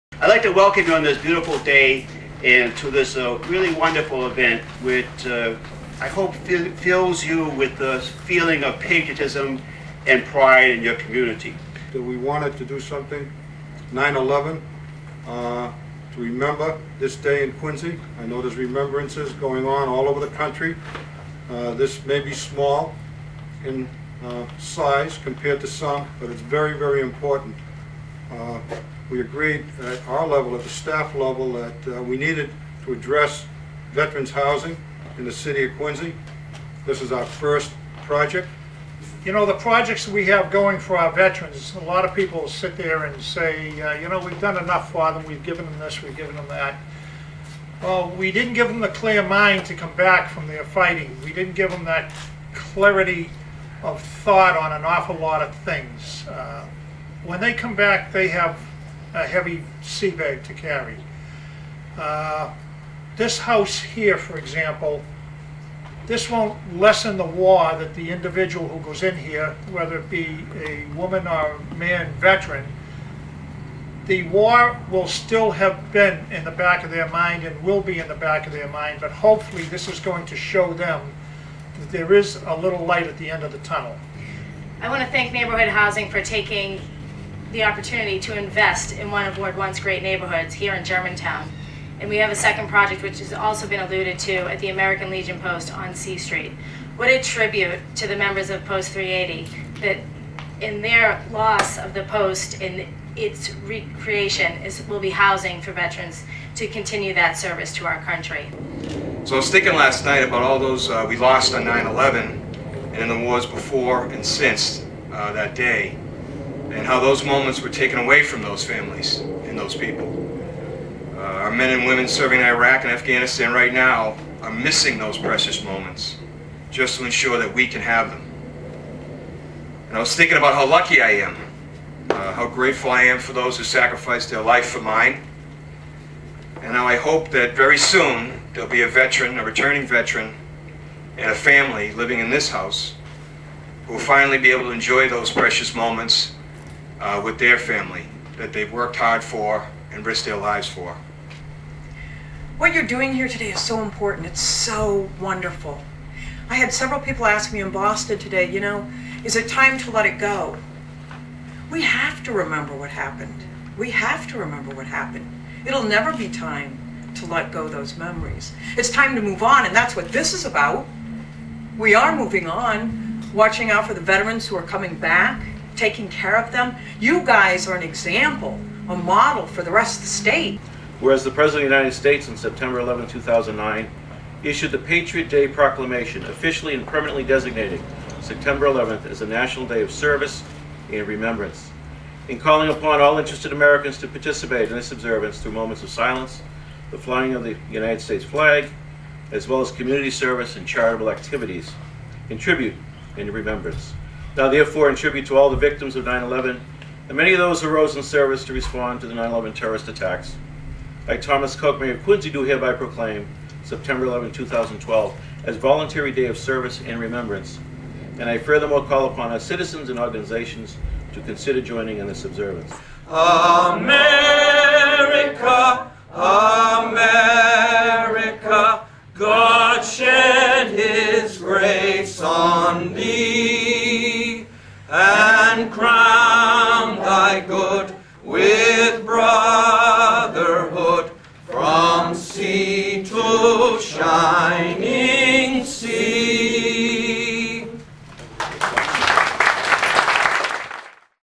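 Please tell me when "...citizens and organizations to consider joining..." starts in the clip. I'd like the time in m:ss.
3:39.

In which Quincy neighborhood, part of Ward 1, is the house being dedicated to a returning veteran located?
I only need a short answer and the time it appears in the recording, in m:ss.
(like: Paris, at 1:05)
Germantown, at 1:30.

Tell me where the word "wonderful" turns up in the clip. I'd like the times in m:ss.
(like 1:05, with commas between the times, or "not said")
0:03, 2:35.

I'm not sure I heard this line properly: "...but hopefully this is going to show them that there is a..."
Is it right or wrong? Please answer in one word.
right.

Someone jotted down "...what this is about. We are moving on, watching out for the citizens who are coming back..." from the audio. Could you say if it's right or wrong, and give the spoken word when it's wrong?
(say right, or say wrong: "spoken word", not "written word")
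wrong: "veterans", not "citizens".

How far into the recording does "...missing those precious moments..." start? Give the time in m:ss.
2:04.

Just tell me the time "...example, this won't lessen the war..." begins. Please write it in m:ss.
1:04.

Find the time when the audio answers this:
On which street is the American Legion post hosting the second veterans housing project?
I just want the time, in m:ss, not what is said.
1:35.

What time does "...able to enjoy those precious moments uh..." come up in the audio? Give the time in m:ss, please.
2:24.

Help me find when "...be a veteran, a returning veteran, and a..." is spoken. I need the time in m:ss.
2:18.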